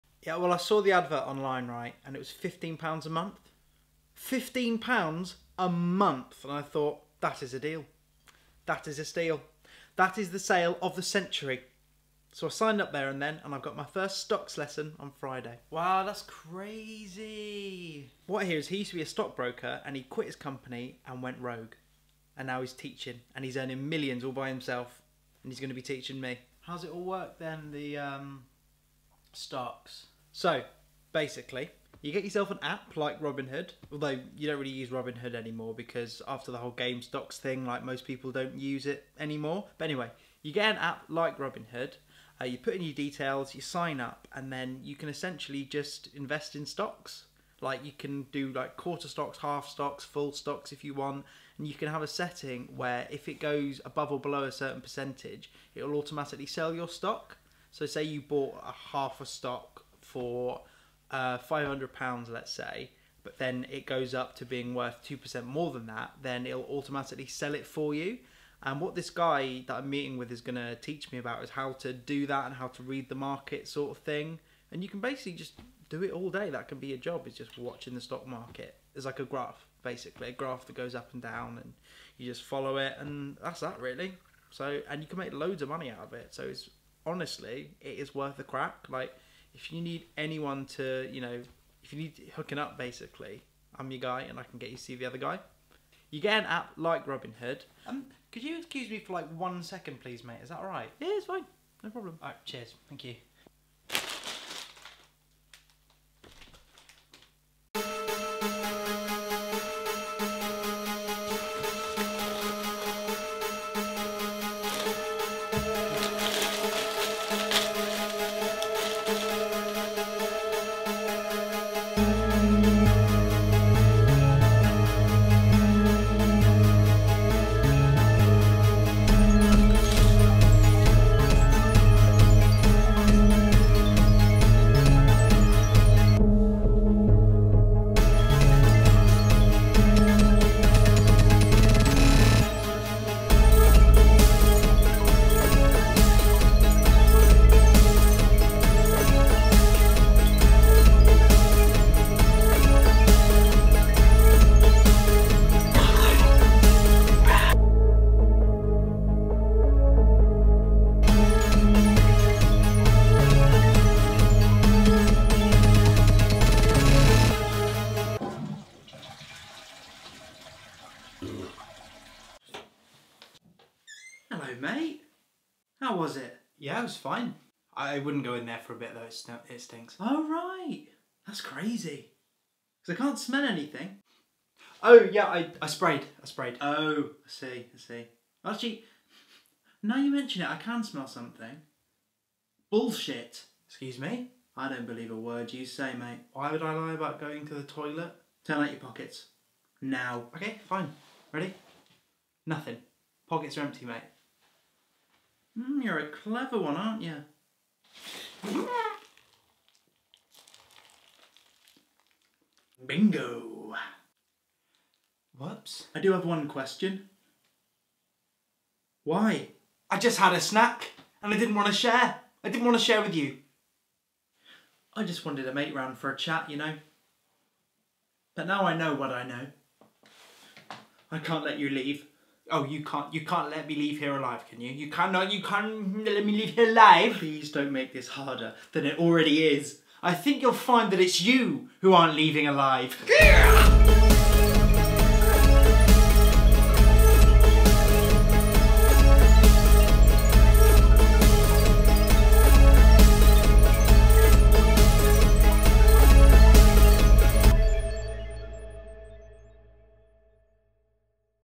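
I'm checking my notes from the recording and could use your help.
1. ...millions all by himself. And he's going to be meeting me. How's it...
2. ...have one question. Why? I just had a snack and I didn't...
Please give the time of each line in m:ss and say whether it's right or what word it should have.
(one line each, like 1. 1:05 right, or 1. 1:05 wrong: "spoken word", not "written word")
1. 0:23 wrong: "teaching", not "meeting"
2. 3:36 right.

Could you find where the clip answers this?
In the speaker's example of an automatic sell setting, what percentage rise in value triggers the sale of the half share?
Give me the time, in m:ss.
1:05.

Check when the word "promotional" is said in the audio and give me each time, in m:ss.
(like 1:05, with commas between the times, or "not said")
not said.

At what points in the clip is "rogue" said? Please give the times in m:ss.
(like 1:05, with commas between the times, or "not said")
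0:21.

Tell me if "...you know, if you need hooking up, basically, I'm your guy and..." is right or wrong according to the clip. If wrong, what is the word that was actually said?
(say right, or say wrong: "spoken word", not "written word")
right.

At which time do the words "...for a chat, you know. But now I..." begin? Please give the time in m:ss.
3:45.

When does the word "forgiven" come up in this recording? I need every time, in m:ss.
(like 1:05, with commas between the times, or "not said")
not said.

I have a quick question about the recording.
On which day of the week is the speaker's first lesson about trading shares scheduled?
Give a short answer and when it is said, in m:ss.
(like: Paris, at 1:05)
Friday, at 0:15.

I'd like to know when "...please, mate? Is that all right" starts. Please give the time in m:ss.
1:40.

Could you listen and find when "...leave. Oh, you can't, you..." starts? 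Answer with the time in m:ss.
3:51.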